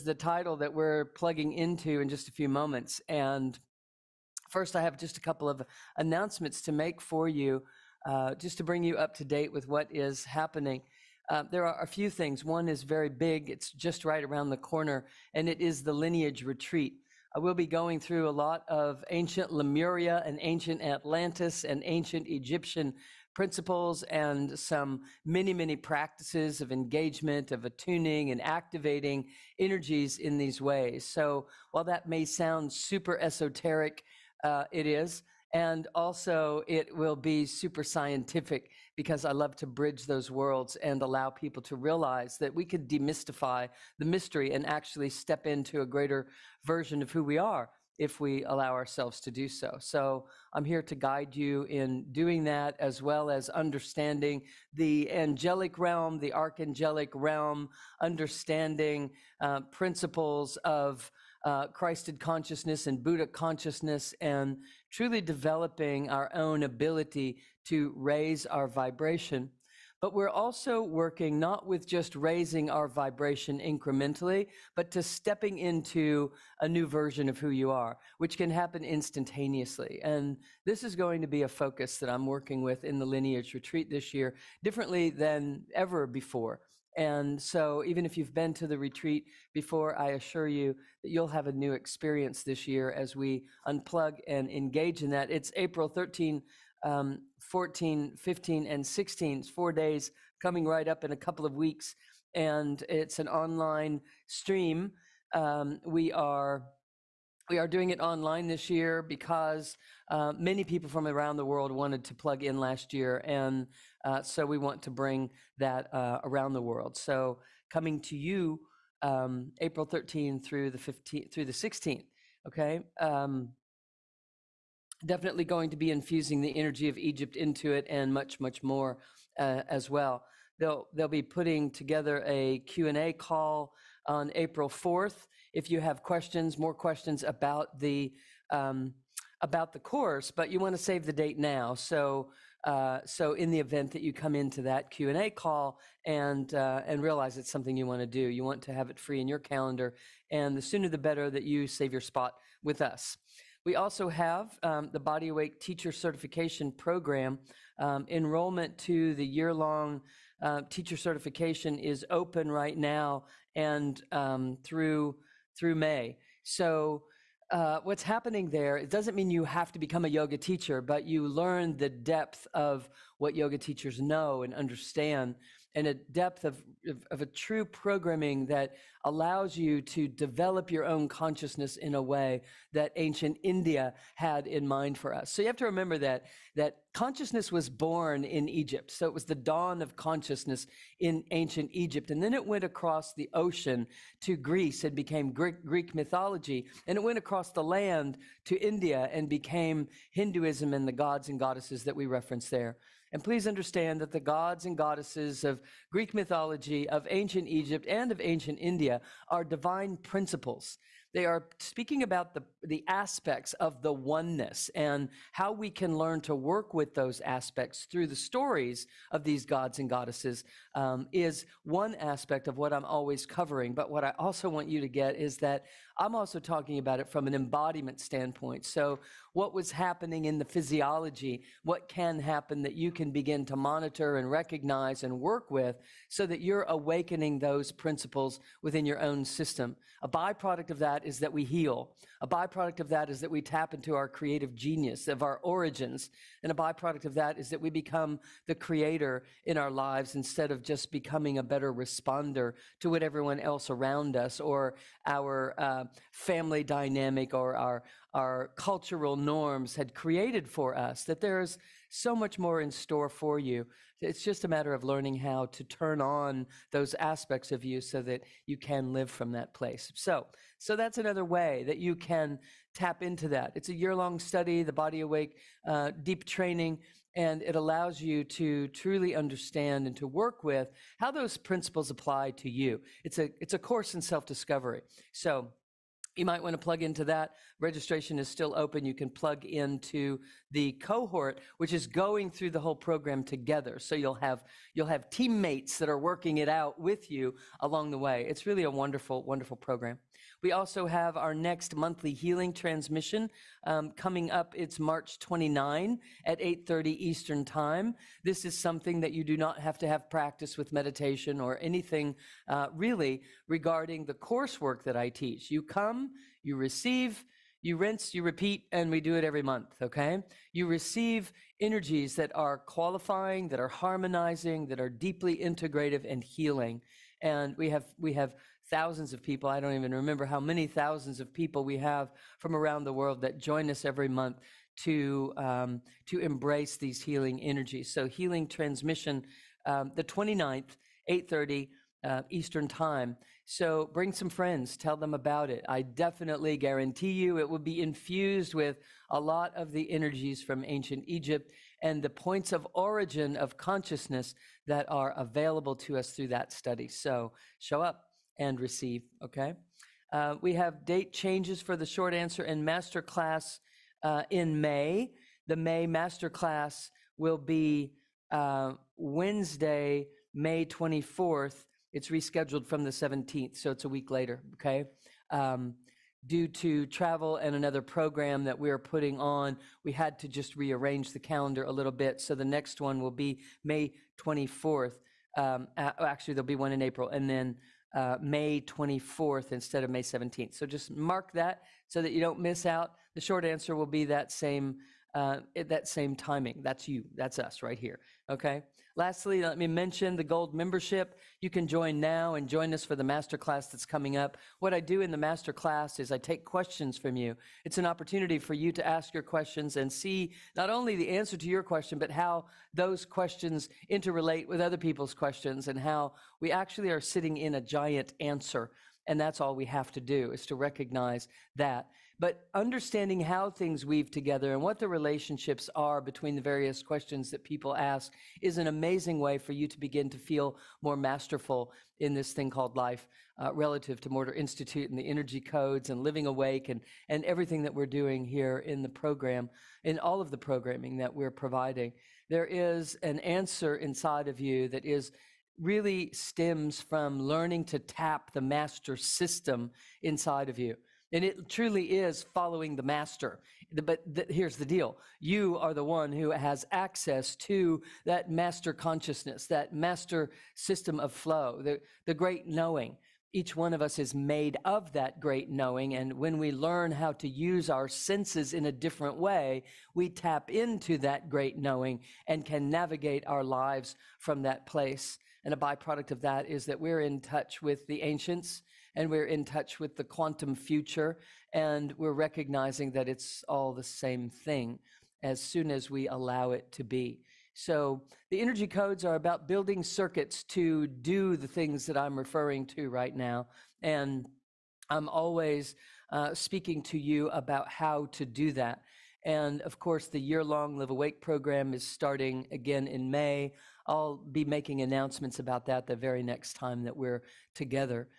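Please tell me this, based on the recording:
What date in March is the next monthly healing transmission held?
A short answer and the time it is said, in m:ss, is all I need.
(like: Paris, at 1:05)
March 29, at 5:04.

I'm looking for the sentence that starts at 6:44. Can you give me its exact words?
What I do in the masterclass is I take questions from you.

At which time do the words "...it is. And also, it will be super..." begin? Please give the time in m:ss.
0:34.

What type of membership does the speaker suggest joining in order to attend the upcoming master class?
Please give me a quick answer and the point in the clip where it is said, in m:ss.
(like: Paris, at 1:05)
Gold membership, at 6:40.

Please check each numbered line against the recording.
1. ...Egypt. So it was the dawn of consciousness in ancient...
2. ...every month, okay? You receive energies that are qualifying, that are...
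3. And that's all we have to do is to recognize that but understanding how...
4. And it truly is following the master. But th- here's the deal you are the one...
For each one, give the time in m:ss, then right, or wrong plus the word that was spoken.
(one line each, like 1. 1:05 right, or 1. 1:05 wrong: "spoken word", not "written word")
1. 3:08 right
2. 5:19 right
3. 6:59 right
4. 7:31 right.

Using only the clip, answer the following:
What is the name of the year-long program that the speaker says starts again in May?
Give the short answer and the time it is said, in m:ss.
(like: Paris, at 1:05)
Live Awake, at 8:20.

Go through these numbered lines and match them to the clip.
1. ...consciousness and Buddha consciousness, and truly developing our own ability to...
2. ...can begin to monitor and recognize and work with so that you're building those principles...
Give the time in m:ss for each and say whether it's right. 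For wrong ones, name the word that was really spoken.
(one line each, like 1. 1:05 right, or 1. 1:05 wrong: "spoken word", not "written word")
1. 1:02 right
2. 3:52 wrong: "awakening", not "building".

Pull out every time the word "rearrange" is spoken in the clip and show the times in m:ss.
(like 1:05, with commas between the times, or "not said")
6:20.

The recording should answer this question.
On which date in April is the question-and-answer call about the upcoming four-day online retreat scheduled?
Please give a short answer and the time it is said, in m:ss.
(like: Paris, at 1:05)
April 4, at 2:14.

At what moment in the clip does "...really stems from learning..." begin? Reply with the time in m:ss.
7:25.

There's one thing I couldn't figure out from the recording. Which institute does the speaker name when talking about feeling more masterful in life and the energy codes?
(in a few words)
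Morter Institute.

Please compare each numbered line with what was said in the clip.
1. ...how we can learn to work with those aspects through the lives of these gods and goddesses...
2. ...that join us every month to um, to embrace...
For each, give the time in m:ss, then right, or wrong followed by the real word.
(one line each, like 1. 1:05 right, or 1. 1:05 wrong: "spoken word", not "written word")
1. 3:35 wrong: "stories", not "lives"
2. 5:33 right.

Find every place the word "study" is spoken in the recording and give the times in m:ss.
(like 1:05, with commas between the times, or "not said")
4:34, 5:56.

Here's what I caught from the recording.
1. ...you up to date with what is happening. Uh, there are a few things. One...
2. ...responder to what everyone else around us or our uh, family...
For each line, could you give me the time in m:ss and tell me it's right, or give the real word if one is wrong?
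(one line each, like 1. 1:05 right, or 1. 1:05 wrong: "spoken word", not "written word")
1. 0:08 right
2. 4:11 right.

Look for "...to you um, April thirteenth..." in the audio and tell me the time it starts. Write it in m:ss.
1:58.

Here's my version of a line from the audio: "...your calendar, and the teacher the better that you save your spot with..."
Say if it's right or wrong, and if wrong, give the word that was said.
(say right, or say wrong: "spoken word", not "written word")
wrong: "sooner", not "teacher".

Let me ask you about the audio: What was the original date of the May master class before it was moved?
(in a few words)
May 17.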